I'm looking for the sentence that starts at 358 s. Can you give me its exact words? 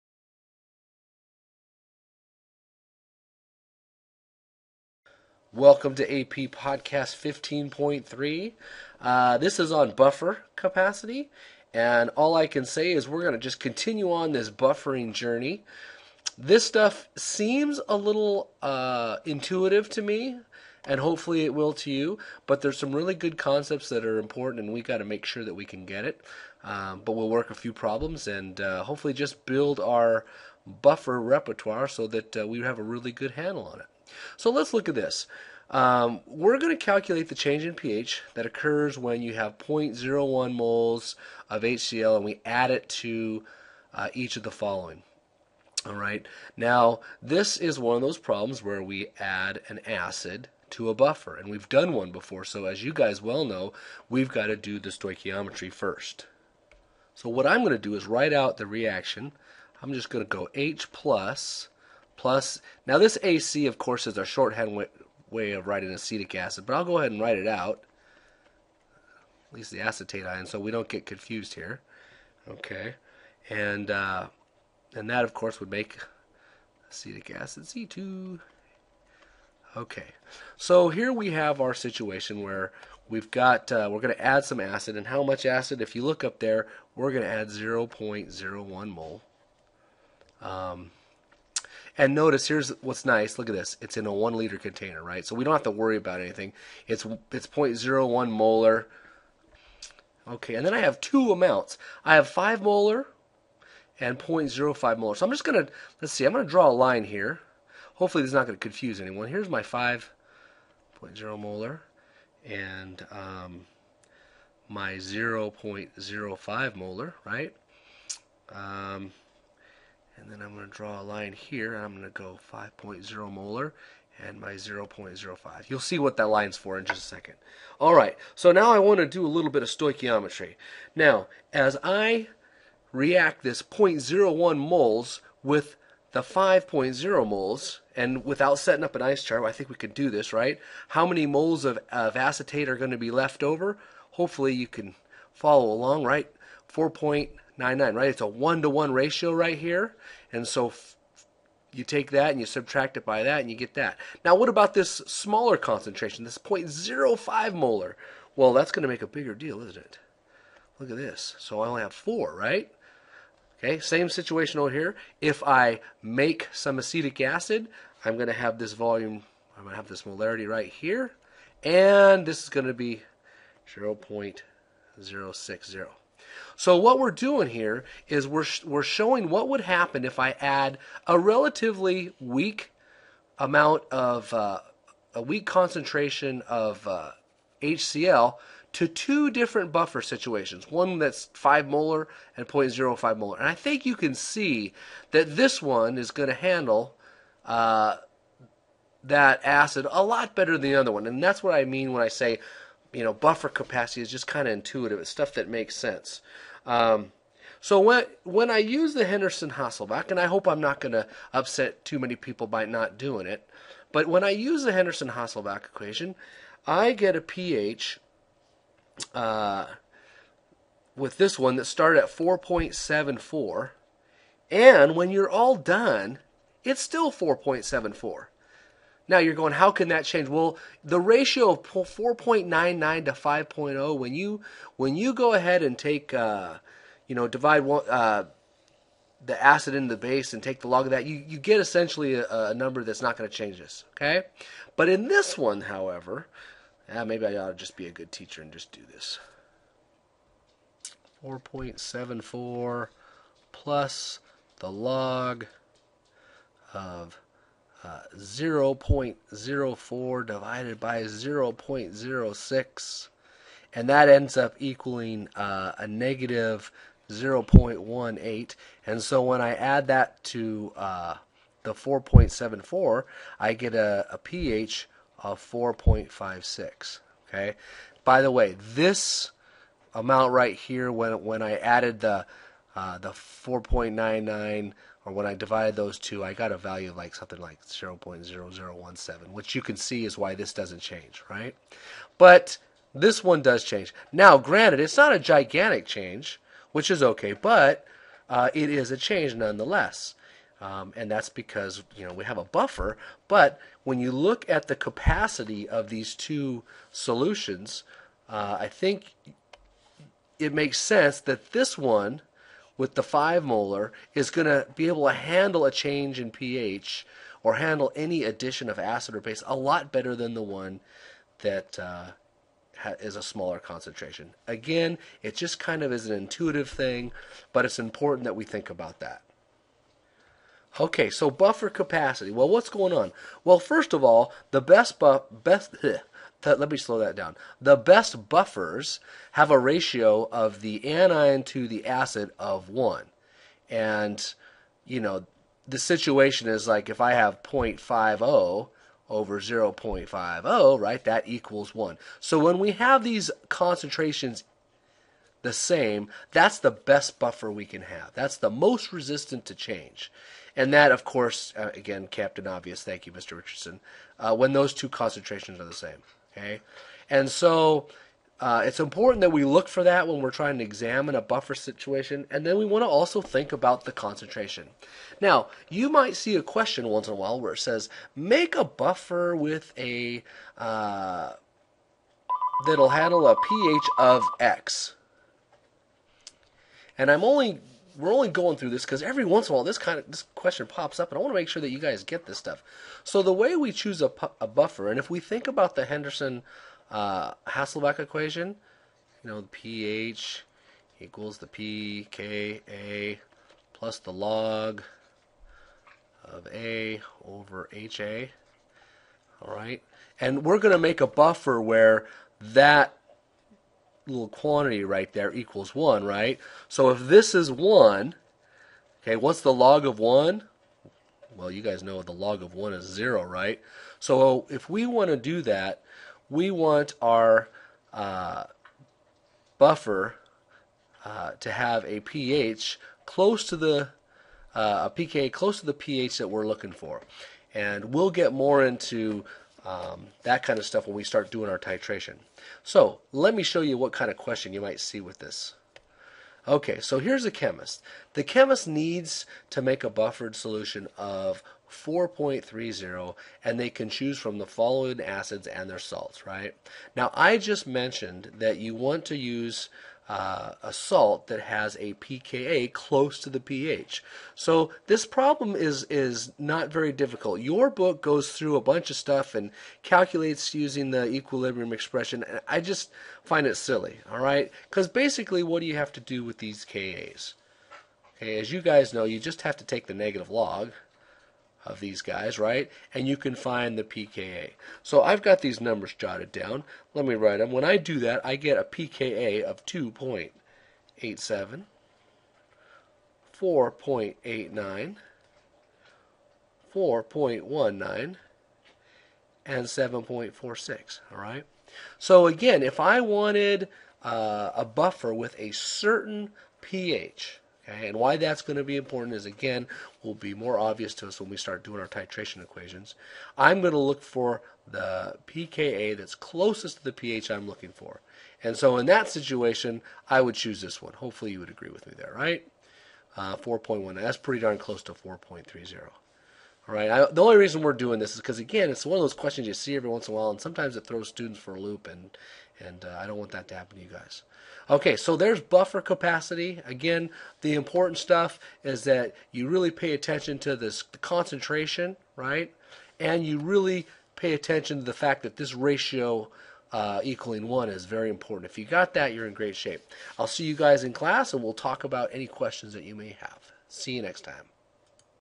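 That's the most resistant to change.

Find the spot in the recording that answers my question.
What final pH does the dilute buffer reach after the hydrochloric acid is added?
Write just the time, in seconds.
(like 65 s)
275 s.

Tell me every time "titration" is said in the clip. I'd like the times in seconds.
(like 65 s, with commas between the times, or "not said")
441 s, 511 s.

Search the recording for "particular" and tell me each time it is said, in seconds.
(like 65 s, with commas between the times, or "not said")
not said.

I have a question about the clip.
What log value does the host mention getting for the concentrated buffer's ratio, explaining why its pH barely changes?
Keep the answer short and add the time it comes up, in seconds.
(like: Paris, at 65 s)
0.0017, at 287 s.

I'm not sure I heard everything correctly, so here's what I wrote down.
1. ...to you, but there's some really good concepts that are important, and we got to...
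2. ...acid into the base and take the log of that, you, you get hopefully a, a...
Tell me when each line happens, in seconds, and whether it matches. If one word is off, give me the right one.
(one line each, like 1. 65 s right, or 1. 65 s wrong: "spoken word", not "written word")
1. 21 s right
2. 239 s wrong: "essentially", not "hopefully".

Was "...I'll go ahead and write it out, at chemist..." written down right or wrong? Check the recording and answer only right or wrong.
wrong.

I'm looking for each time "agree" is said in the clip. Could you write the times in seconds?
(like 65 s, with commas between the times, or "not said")
521 s.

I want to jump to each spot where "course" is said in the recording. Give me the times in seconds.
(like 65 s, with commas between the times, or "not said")
63 s, 75 s, 361 s.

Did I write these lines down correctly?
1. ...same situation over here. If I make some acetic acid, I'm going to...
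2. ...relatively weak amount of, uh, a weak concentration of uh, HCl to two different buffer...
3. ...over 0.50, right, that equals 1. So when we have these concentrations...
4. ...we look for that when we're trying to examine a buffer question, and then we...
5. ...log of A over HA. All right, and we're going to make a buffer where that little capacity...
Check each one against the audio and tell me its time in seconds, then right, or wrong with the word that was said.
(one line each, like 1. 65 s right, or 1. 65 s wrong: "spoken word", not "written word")
1. 163 s right
2. 181 s right
3. 349 s right
4. 369 s wrong: "situation", not "question"
5. 404 s wrong: "quantity", not "capacity".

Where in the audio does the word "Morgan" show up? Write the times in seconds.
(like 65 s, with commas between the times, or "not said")
not said.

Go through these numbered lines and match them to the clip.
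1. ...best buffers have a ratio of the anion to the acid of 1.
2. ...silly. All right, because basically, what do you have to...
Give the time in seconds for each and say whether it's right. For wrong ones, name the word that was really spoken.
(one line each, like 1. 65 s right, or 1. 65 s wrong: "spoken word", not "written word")
1. 337 s right
2. 473 s right.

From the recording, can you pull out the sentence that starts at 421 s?
Well, you guys know the log of 1 is 0, right?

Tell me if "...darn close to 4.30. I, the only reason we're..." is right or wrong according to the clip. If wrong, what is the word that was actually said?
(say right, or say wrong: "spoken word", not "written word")
right.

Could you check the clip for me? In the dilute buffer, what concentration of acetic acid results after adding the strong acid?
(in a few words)
0.060.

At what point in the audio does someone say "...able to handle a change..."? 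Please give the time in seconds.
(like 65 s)
314 s.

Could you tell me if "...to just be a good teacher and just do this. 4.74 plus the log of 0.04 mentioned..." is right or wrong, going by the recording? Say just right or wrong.
wrong.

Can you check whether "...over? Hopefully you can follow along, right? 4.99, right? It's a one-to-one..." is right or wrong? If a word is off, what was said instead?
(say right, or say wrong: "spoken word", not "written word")
right.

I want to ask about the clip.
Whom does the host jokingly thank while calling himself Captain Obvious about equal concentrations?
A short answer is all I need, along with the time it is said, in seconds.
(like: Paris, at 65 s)
Mr. Richardson, at 363 s.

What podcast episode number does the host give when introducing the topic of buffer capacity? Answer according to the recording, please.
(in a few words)
15.3.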